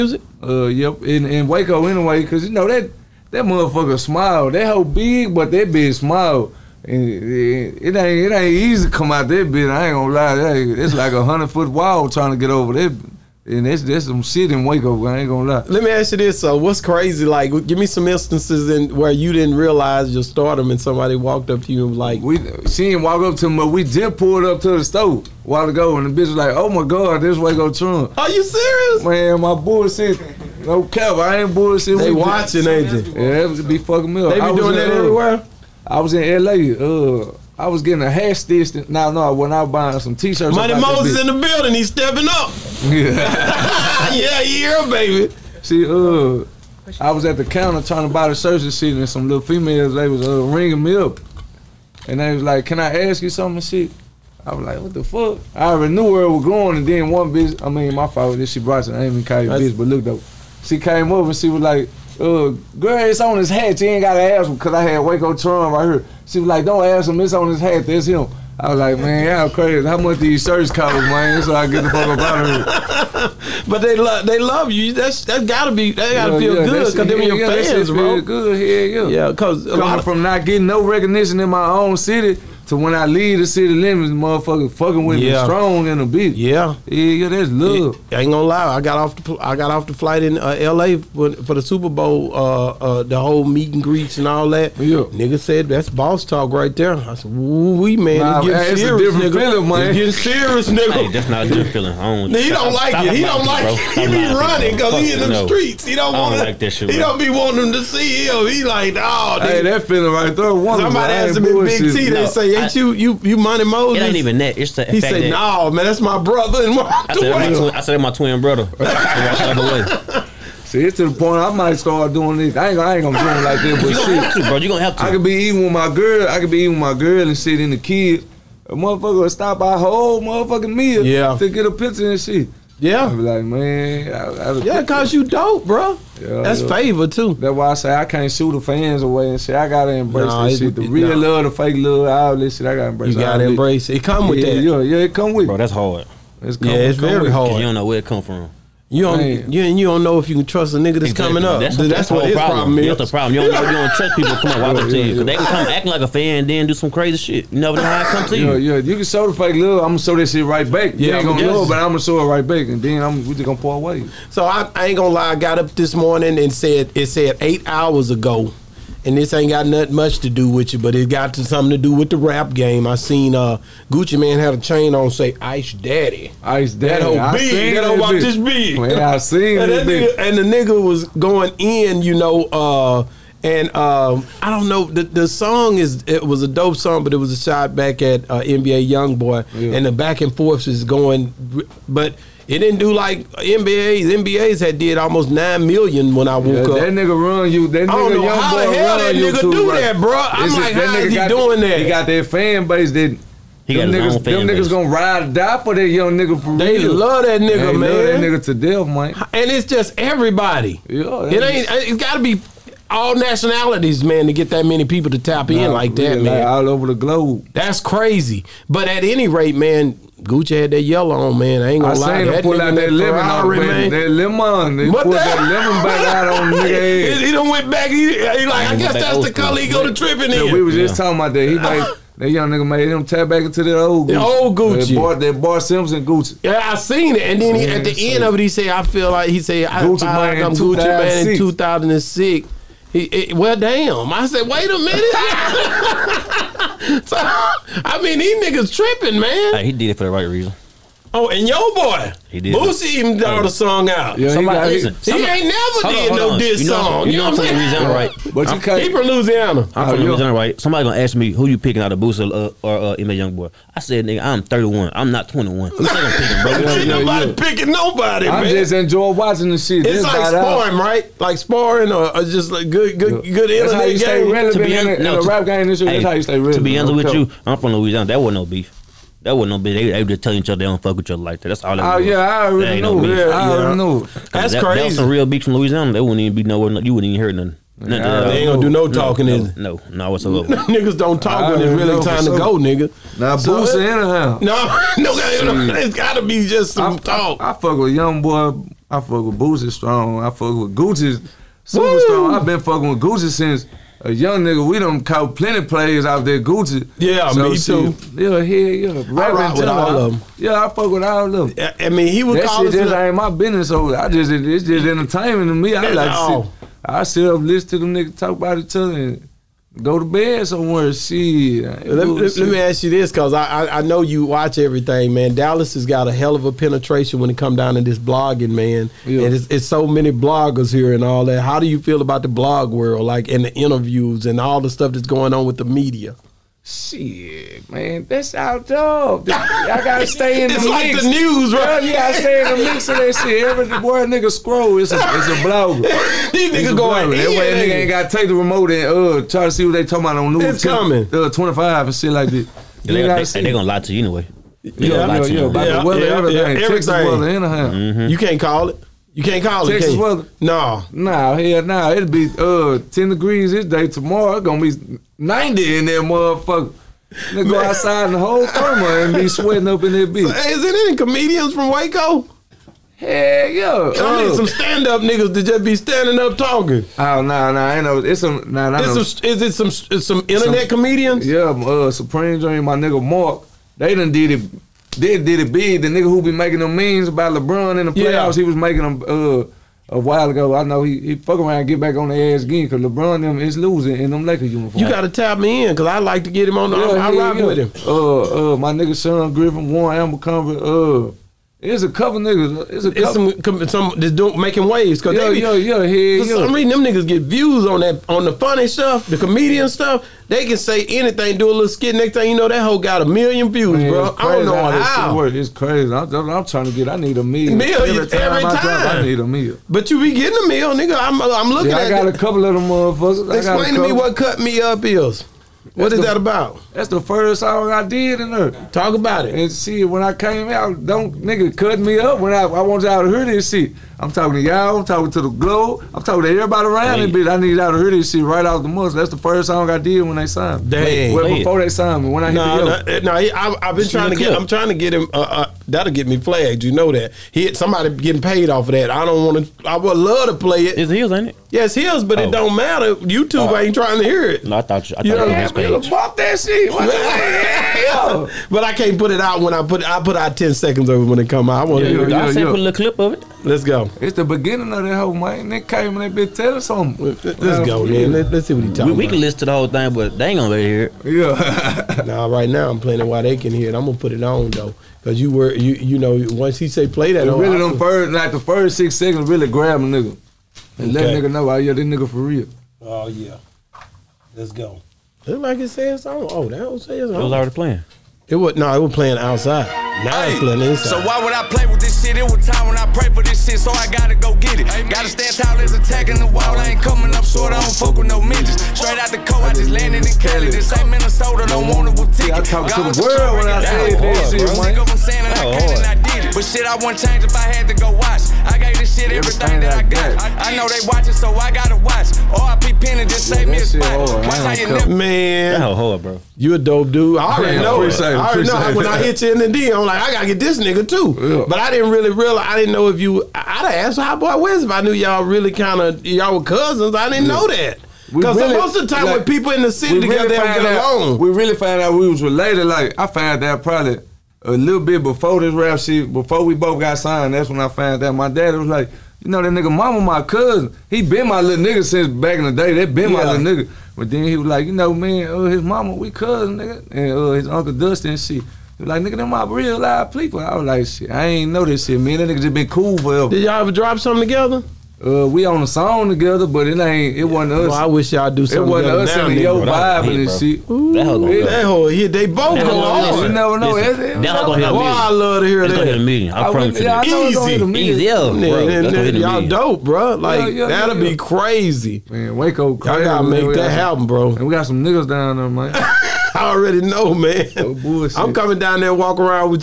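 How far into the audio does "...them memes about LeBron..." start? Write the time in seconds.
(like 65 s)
386 s.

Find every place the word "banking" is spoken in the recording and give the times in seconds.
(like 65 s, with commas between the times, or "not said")
not said.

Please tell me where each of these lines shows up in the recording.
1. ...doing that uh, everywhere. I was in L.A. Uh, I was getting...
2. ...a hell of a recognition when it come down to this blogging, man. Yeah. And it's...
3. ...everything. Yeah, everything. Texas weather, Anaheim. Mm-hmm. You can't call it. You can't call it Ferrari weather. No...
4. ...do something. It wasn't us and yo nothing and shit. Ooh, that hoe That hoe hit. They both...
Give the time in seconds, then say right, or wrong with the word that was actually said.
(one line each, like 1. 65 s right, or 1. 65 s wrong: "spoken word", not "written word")
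1. 34 s right
2. 326 s wrong: "penetration", not "recognition"
3. 356 s wrong: "Texas", not "Ferrari"
4. 558 s wrong: "vibing", not "nothing".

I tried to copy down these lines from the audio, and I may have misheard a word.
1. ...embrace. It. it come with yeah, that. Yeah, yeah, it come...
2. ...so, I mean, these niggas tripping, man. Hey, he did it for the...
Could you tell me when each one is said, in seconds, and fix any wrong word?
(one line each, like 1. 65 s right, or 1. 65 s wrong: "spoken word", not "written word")
1. 143 s right
2. 247 s right.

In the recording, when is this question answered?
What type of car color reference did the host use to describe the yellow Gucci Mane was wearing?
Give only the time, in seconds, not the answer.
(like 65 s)
222 s.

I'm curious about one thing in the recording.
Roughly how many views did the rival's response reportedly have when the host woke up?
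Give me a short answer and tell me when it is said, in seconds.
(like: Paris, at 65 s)
9 million, at 195 s.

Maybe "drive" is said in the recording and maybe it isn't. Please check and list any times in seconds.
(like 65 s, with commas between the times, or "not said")
418 s.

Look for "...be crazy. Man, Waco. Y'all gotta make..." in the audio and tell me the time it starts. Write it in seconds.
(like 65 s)
570 s.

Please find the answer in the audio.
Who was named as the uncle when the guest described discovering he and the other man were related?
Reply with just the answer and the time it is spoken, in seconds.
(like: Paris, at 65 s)
Dustin, at 547 s.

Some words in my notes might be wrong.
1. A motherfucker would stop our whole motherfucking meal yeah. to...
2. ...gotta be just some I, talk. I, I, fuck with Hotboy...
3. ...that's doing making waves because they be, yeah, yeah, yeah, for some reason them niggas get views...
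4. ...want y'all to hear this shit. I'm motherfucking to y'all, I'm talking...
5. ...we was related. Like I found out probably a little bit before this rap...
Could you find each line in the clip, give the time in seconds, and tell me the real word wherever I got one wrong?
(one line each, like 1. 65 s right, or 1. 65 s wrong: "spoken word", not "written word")
1. 128 s right
2. 295 s wrong: "Young", not "Hotboy"
3. 403 s right
4. 432 s wrong: "talking", not "motherfucking"
5. 531 s right.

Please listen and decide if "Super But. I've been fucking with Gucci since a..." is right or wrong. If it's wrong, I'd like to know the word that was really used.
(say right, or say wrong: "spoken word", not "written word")
wrong: "Strong", not "But".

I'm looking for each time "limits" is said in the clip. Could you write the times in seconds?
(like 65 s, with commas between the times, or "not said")
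83 s.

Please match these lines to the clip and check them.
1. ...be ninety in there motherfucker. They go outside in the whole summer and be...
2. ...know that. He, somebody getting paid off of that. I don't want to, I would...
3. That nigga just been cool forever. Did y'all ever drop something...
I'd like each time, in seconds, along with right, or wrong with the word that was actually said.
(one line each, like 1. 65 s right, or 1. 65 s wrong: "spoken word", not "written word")
1. 364 s right
2. 446 s right
3. 552 s right.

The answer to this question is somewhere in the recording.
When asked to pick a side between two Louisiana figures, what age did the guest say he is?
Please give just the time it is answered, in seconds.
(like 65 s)
264 s.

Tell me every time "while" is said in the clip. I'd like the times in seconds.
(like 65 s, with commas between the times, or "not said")
25 s, 389 s, 473 s.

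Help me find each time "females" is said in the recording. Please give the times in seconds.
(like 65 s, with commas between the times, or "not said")
49 s.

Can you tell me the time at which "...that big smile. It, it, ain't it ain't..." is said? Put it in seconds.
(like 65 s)
5 s.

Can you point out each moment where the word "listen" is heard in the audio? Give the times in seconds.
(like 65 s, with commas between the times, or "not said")
254 s, 317 s, 469 s.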